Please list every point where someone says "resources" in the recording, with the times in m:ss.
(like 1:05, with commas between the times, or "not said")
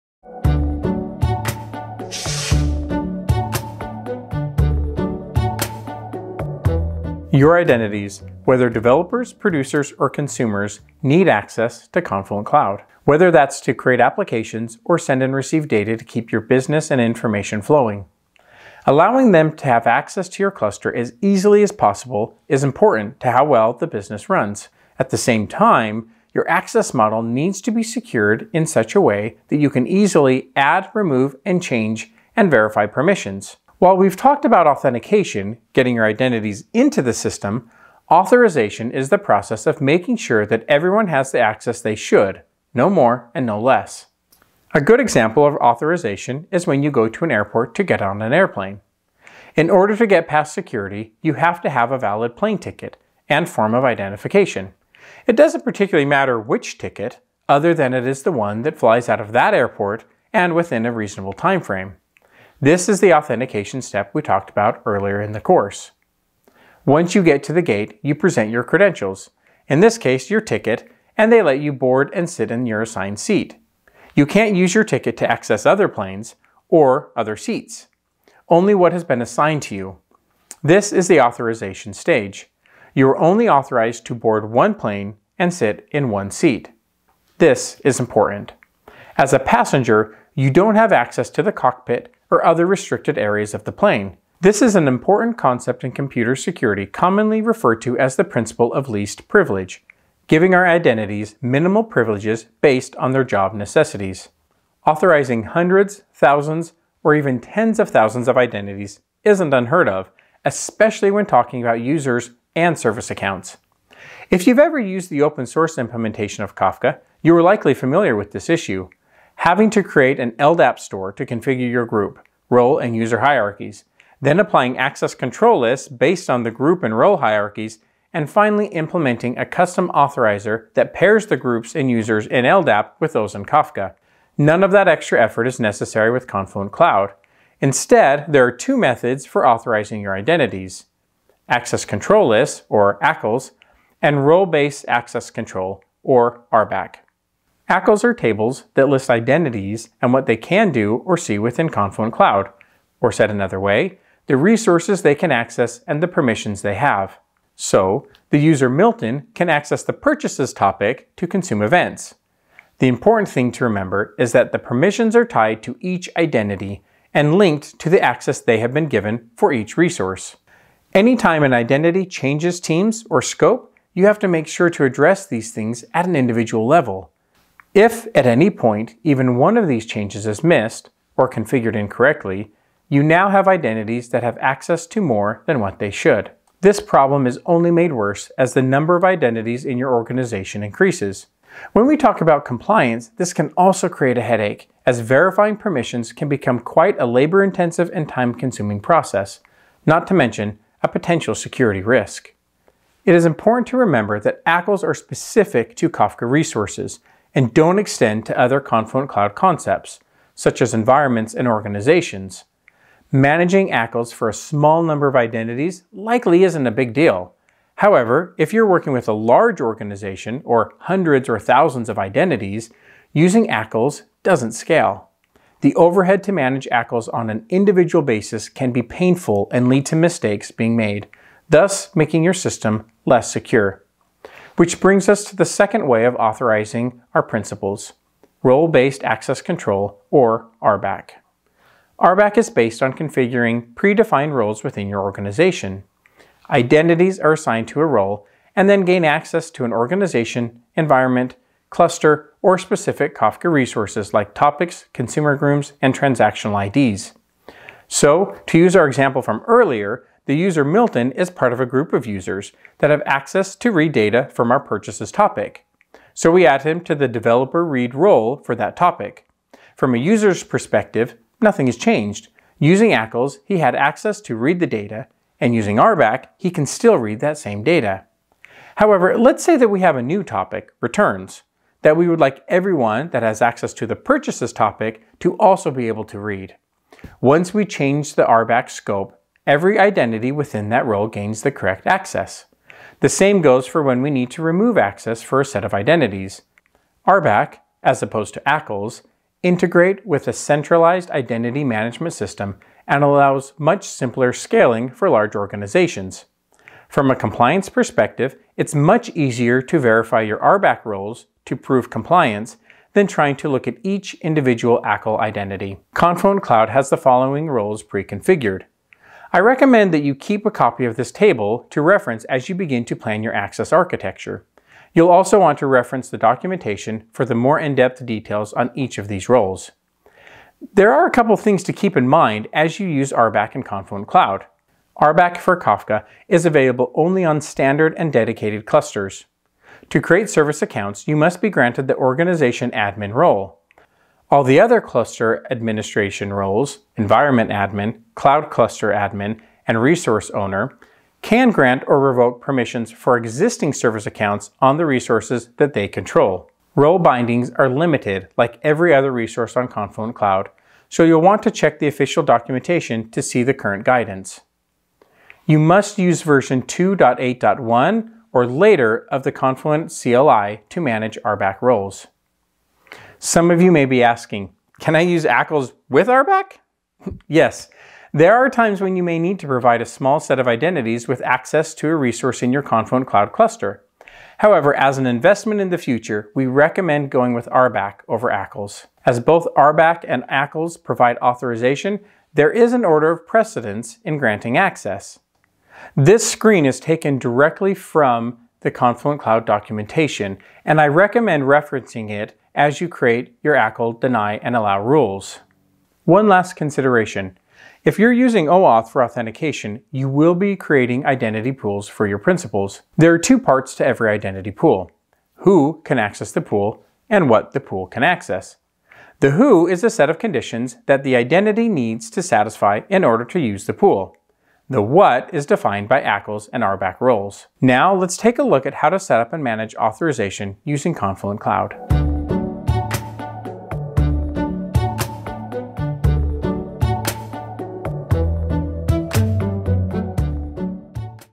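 2:34, 2:49, 3:26, 4:13, 5:49, 5:54, 5:59, 6:21.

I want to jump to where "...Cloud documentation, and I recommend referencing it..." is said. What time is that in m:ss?
6:39.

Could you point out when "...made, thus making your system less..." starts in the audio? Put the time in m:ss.
3:50.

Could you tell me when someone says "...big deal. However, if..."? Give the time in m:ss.
3:36.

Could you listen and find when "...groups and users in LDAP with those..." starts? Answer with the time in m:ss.
2:11.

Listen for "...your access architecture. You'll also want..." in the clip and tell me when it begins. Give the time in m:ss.
5:23.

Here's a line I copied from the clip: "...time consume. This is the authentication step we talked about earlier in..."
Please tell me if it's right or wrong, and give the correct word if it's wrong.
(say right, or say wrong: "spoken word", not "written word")
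wrong: "frame", not "consume".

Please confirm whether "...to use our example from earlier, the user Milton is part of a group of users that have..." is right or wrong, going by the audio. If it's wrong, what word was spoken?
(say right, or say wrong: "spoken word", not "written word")
right.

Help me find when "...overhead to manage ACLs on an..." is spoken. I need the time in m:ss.
3:45.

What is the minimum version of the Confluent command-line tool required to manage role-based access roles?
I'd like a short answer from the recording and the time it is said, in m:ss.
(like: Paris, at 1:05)
2.8.1, at 6:06.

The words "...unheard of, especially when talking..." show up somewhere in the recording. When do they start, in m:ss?
1:49.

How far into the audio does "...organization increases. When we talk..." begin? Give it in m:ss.
3:09.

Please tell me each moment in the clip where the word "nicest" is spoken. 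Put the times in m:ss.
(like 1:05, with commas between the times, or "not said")
not said.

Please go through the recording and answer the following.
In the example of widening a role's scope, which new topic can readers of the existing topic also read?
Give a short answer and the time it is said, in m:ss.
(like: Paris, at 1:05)
returns, at 4:40.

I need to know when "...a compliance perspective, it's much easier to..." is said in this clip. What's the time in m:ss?
5:07.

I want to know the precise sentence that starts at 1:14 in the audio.
You can't use your ticket to access other planes or other seats, only what has been assigned to you.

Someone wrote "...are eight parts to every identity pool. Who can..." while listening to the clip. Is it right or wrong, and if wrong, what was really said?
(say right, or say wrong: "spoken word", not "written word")
wrong: "two", not "eight".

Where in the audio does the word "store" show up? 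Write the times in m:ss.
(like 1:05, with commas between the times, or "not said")
2:00.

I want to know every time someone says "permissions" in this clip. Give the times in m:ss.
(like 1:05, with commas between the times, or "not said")
0:32, 2:36, 2:44, 3:15, 5:52.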